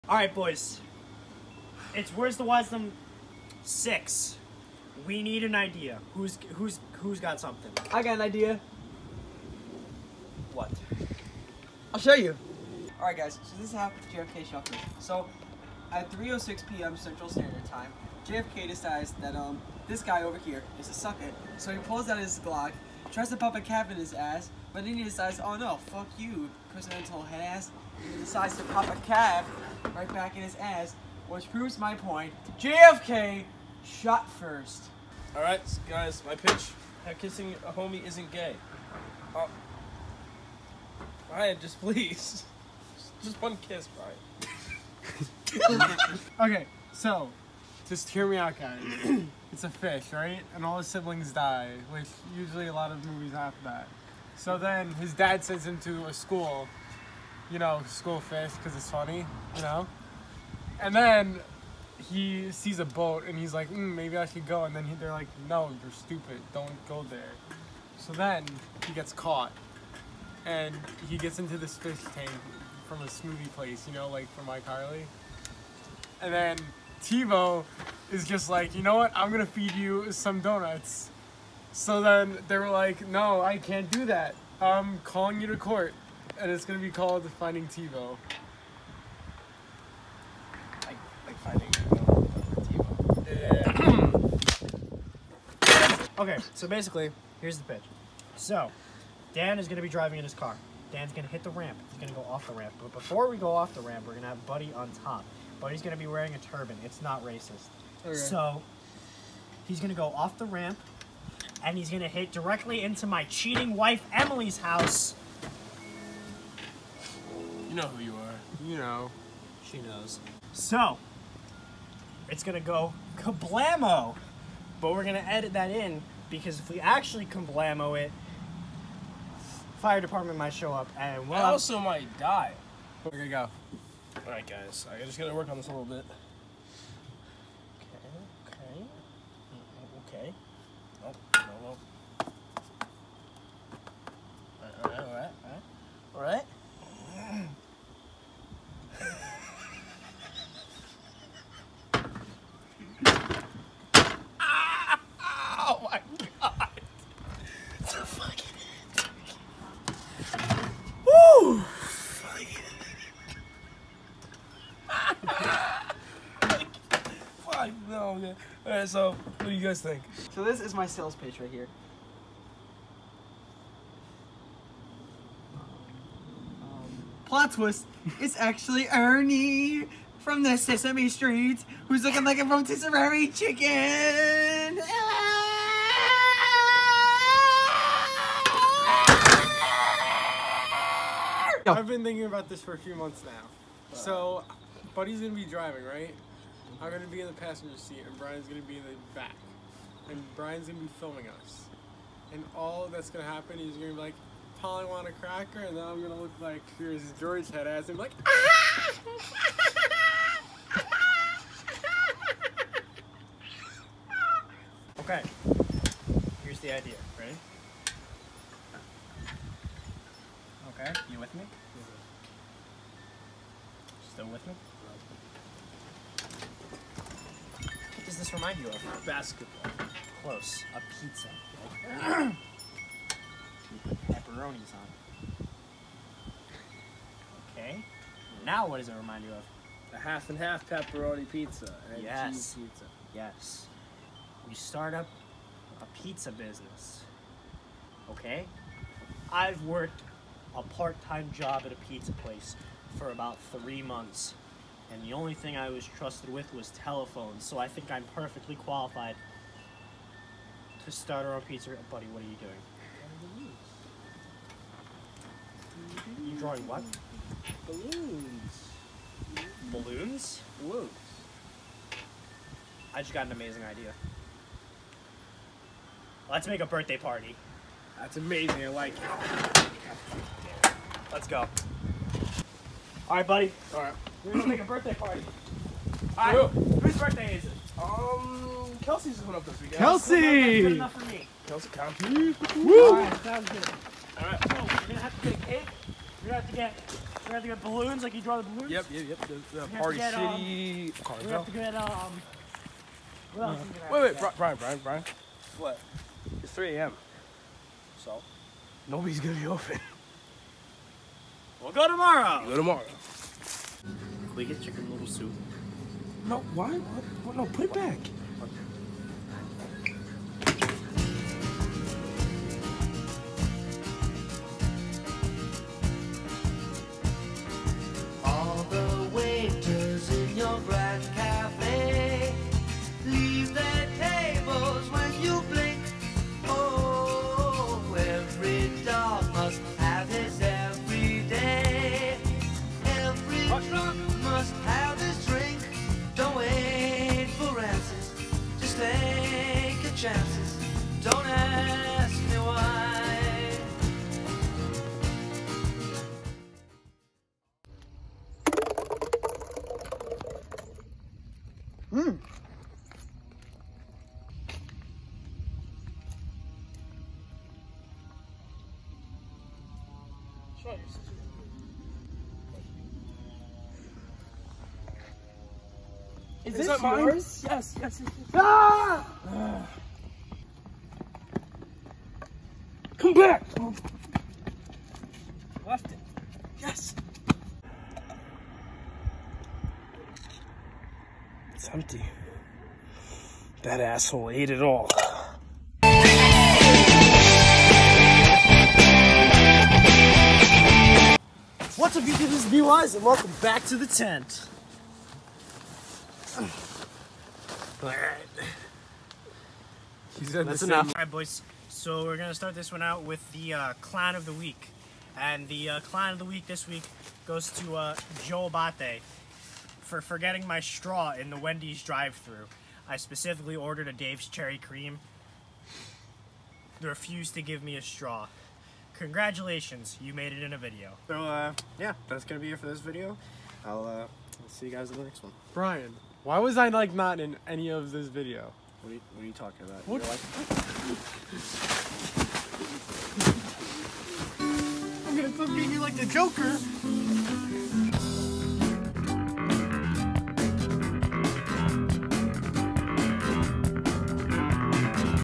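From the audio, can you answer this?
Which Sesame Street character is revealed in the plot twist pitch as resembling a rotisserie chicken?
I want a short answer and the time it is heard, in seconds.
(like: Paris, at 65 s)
Ernie, at 178 s.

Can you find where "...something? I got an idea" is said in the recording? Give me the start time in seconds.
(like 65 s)
7 s.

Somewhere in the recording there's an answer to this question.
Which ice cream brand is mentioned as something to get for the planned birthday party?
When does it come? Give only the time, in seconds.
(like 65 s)
301 s.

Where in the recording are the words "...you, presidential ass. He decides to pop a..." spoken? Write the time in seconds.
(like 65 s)
26 s.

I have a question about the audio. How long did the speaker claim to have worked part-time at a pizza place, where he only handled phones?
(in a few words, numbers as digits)
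3 months.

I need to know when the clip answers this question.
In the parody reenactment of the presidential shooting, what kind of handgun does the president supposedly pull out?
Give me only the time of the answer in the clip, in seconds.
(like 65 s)
22 s.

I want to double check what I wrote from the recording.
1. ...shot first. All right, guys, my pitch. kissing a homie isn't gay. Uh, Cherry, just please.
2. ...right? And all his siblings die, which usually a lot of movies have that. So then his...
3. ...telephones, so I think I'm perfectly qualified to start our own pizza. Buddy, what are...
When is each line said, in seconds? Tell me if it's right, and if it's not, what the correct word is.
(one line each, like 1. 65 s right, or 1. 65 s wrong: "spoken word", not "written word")
1. 33 s wrong: "Brian", not "Cherry"
2. 50 s right
3. 256 s right.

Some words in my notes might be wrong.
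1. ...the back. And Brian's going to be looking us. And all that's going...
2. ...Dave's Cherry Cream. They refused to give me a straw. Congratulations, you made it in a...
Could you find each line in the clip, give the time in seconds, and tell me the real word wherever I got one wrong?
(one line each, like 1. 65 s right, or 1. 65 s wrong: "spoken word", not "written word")
1. 198 s wrong: "filming", not "looking"
2. 423 s right.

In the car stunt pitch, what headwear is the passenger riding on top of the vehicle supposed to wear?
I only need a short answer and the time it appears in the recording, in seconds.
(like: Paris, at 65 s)
A turban, at 106 s.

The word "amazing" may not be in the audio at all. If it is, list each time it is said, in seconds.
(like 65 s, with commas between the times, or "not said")
273 s, 278 s.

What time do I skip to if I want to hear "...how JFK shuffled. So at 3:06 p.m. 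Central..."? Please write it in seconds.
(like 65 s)
13 s.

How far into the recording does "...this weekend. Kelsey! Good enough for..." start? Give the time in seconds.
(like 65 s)
289 s.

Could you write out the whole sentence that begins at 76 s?
And then TiVo is just like, you know what?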